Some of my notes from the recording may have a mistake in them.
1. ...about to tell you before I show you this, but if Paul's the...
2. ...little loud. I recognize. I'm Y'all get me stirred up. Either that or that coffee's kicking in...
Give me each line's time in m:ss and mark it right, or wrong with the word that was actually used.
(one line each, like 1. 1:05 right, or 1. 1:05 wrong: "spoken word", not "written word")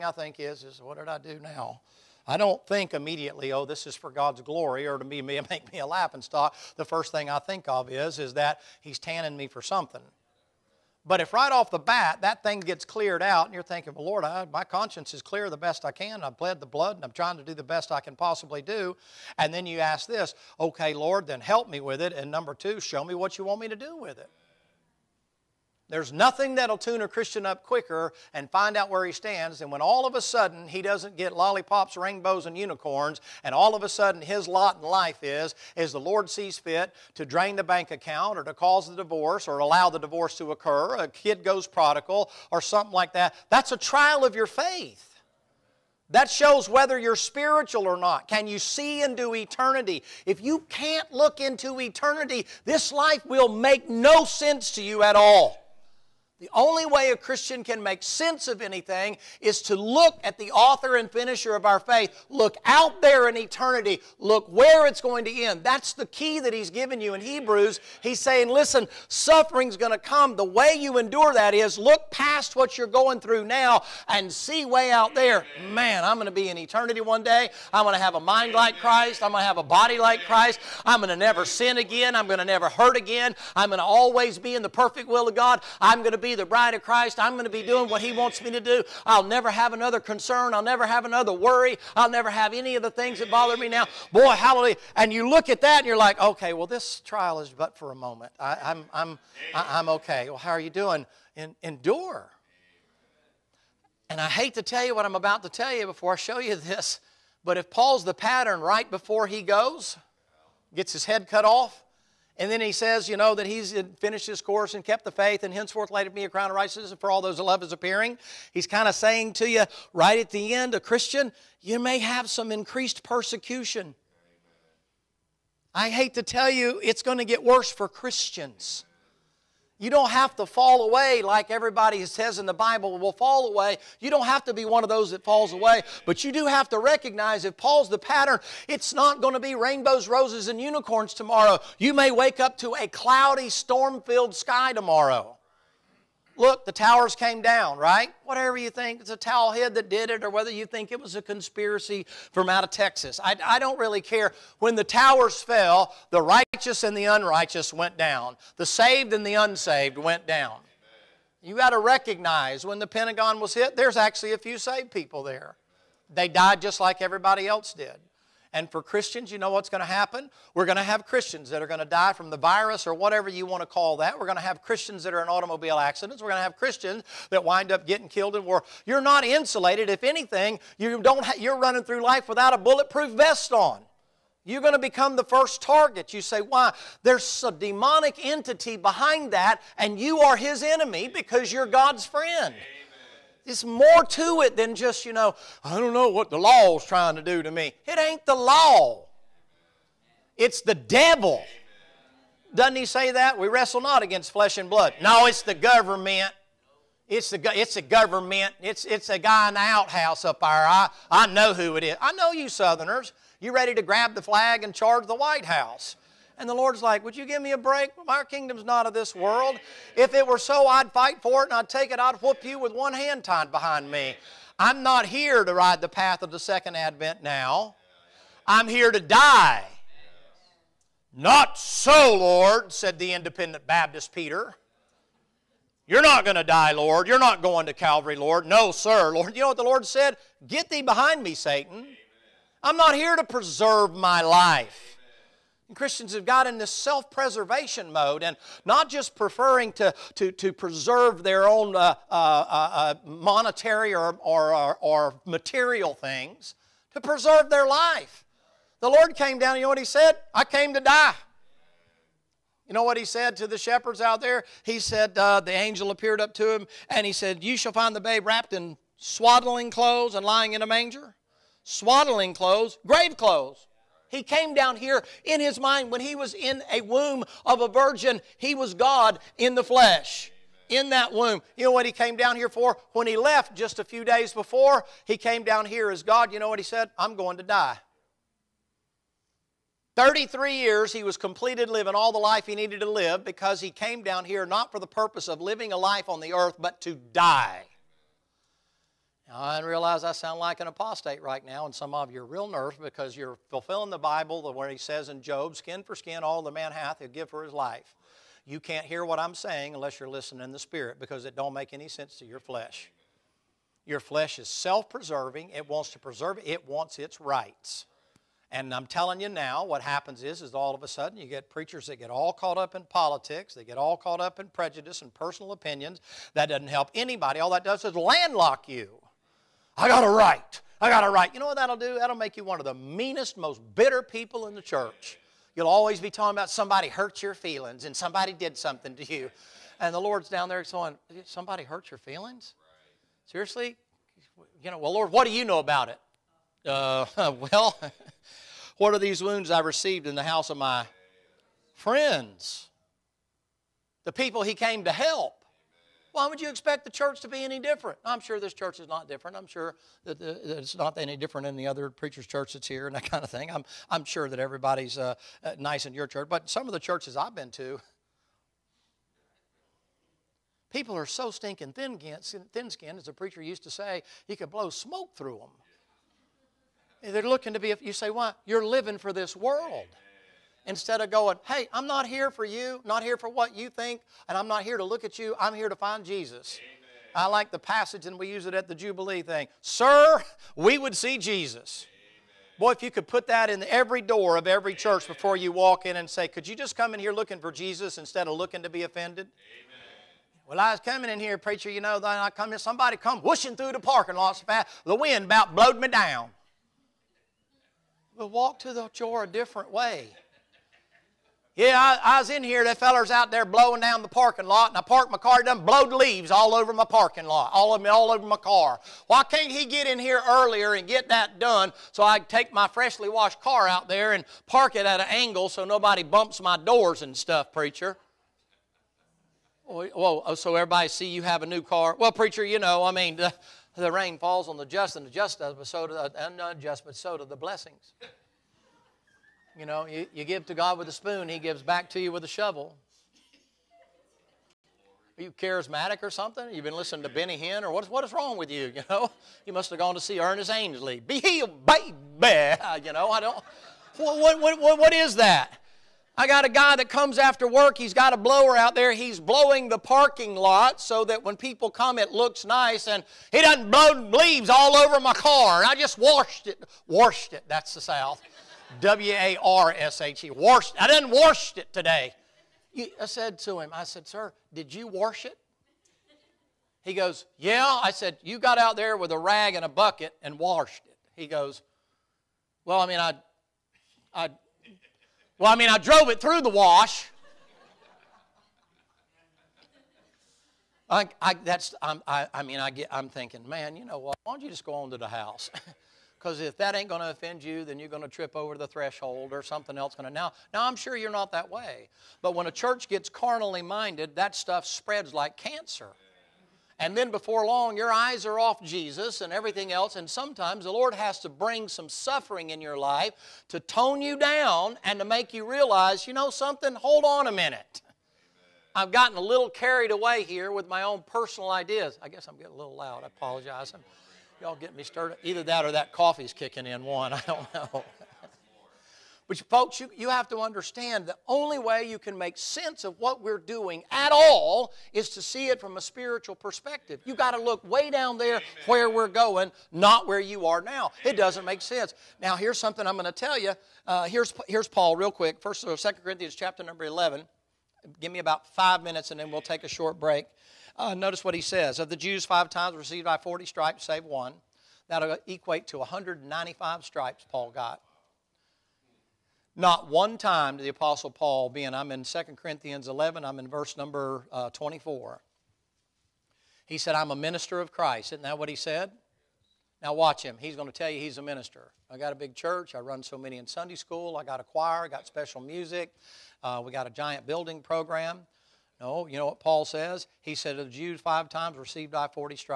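1. 1:45 right
2. 8:42 wrong: "apologize", not "recognize".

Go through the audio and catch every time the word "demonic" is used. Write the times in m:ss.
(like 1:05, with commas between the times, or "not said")
3:07.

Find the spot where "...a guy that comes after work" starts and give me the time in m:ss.
7:36.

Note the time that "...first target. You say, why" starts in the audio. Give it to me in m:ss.
3:05.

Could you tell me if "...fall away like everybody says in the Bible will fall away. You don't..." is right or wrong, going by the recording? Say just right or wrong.
right.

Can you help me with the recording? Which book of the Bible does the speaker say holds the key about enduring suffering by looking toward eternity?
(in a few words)
Hebrews.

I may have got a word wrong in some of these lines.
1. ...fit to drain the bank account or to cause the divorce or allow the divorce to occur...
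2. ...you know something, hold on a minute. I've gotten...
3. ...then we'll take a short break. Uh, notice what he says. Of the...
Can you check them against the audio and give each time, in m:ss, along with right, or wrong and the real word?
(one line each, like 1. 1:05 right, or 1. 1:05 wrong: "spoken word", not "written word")
1. 0:36 right
2. 8:36 right
3. 9:09 right.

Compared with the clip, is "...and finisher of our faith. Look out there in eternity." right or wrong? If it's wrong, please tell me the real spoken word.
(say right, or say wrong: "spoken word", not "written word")
right.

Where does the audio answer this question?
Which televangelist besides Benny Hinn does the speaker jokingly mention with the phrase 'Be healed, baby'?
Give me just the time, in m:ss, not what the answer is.
7:30.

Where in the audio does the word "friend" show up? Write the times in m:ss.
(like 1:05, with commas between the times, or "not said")
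3:12, 5:51.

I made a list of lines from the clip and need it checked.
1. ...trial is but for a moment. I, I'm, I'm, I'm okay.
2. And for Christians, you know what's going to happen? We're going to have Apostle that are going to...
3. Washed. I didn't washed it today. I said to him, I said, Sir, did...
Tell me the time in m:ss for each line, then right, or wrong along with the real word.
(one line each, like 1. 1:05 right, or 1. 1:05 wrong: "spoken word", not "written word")
1. 1:37 right
2. 2:48 wrong: "Christians", not "Apostle"
3. 7:50 right.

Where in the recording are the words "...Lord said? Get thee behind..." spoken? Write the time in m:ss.
3:59.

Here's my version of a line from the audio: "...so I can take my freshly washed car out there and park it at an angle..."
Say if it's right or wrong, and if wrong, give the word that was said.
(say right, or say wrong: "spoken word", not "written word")
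right.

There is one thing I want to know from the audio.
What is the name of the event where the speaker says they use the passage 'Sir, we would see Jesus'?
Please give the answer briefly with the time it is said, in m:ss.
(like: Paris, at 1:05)
Jubilee, at 6:28.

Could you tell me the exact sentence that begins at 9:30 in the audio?
He's going to tell you he's a minister.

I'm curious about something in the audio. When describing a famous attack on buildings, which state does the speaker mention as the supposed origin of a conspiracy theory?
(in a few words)
Texas.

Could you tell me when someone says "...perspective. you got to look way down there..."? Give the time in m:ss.
8:56.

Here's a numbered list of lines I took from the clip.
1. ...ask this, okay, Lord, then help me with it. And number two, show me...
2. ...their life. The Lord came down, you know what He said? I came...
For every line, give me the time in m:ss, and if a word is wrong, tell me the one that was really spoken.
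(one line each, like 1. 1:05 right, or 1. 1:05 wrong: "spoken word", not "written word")
1. 0:19 right
2. 4:17 right.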